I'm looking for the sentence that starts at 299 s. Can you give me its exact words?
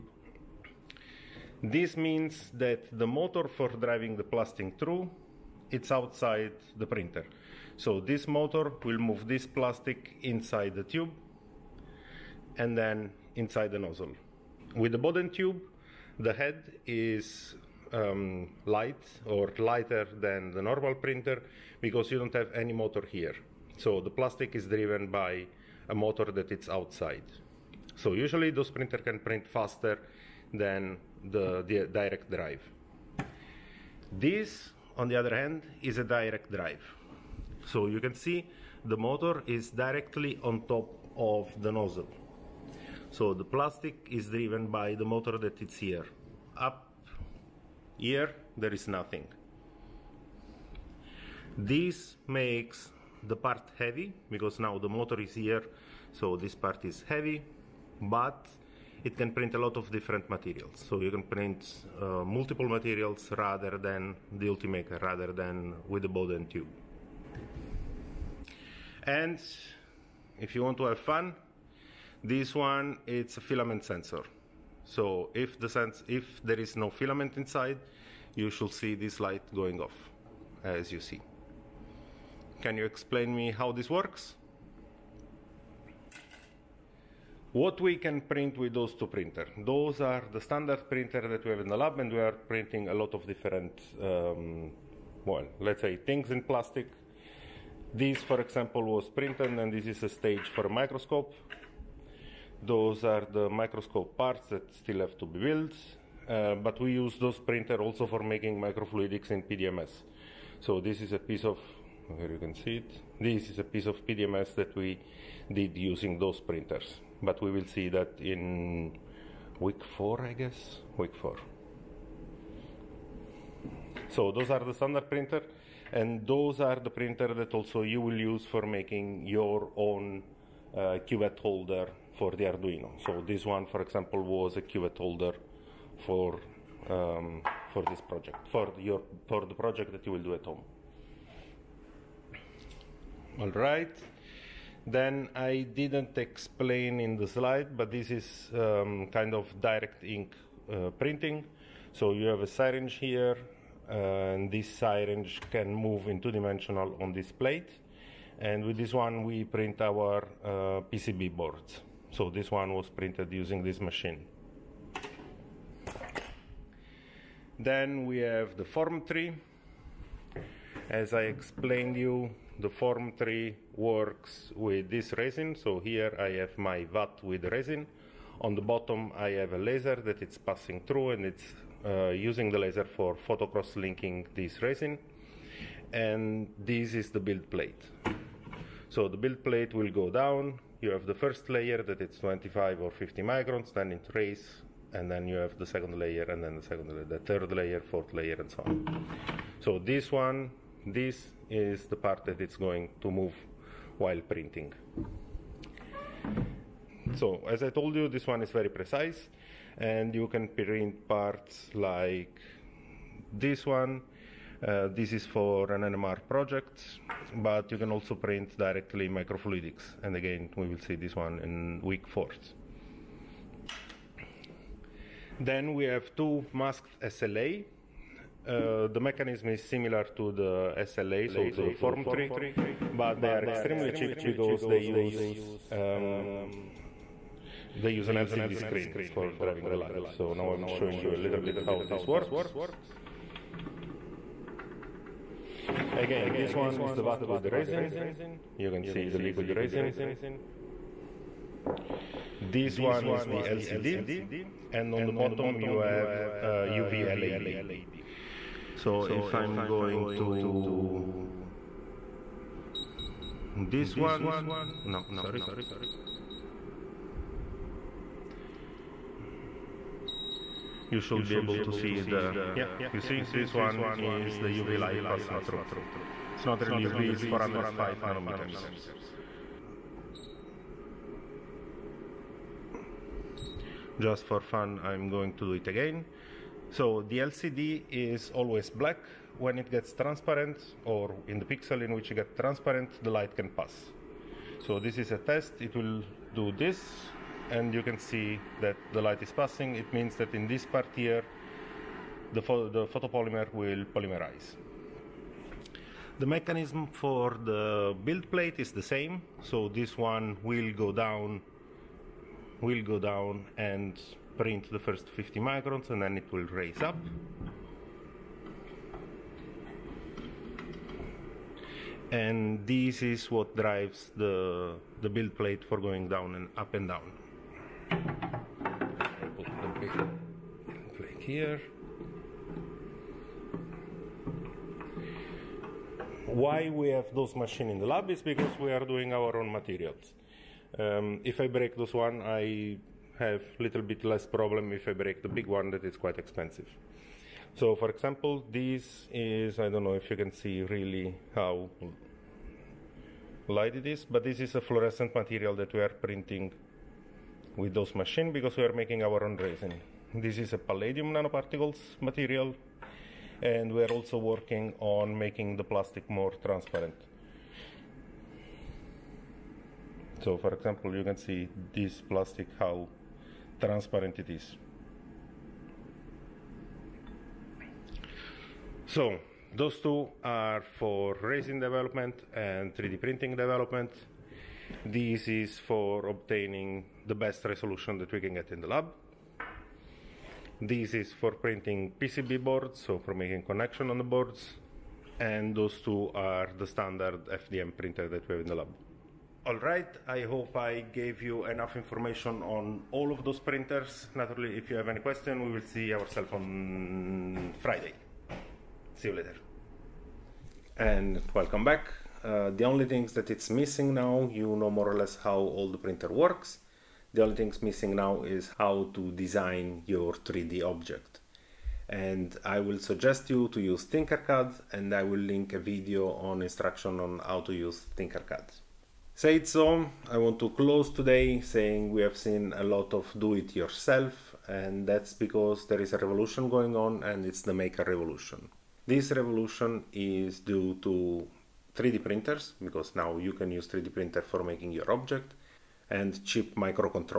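It means that in this part here, the, pho the photopolymer will polymerize.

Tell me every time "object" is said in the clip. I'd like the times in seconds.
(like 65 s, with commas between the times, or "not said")
420 s, 444 s.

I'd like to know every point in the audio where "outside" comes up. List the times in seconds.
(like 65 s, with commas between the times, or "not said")
5 s, 26 s.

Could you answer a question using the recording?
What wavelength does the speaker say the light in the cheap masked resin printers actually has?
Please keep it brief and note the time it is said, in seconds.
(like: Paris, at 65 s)
405 nanometers, at 277 s.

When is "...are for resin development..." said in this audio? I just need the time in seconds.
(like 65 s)
380 s.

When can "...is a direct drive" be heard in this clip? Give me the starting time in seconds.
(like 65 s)
35 s.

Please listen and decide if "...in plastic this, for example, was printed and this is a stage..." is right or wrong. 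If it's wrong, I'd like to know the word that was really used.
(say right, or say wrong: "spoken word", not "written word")
right.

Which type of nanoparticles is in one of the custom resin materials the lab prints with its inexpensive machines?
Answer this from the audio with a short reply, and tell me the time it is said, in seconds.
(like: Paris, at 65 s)
palladium, at 360 s.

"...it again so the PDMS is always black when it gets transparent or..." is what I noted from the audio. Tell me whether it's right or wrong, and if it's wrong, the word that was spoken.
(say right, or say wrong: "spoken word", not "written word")
wrong: "LCD", not "PDMS".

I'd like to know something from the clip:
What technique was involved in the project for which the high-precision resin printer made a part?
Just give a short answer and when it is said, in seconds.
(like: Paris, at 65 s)
NMR, at 215 s.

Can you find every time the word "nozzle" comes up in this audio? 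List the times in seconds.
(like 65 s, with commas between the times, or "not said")
13 s, 41 s.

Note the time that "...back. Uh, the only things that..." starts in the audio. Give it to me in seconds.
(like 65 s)
411 s.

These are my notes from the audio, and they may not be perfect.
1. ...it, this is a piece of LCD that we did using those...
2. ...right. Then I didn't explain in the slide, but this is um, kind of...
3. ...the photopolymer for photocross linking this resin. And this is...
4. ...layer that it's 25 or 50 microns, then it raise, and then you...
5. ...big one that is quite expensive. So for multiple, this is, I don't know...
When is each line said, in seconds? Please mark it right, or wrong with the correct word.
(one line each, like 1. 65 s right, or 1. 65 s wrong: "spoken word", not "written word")
1. 112 s wrong: "PDMS", not "LCD"
2. 143 s right
3. 182 s wrong: "laser", not "photopolymer"
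4. 191 s right
5. 345 s wrong: "example", not "multiple".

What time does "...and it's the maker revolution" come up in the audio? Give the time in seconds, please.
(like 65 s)
437 s.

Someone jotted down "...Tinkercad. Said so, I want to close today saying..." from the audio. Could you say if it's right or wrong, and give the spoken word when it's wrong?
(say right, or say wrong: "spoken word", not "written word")
right.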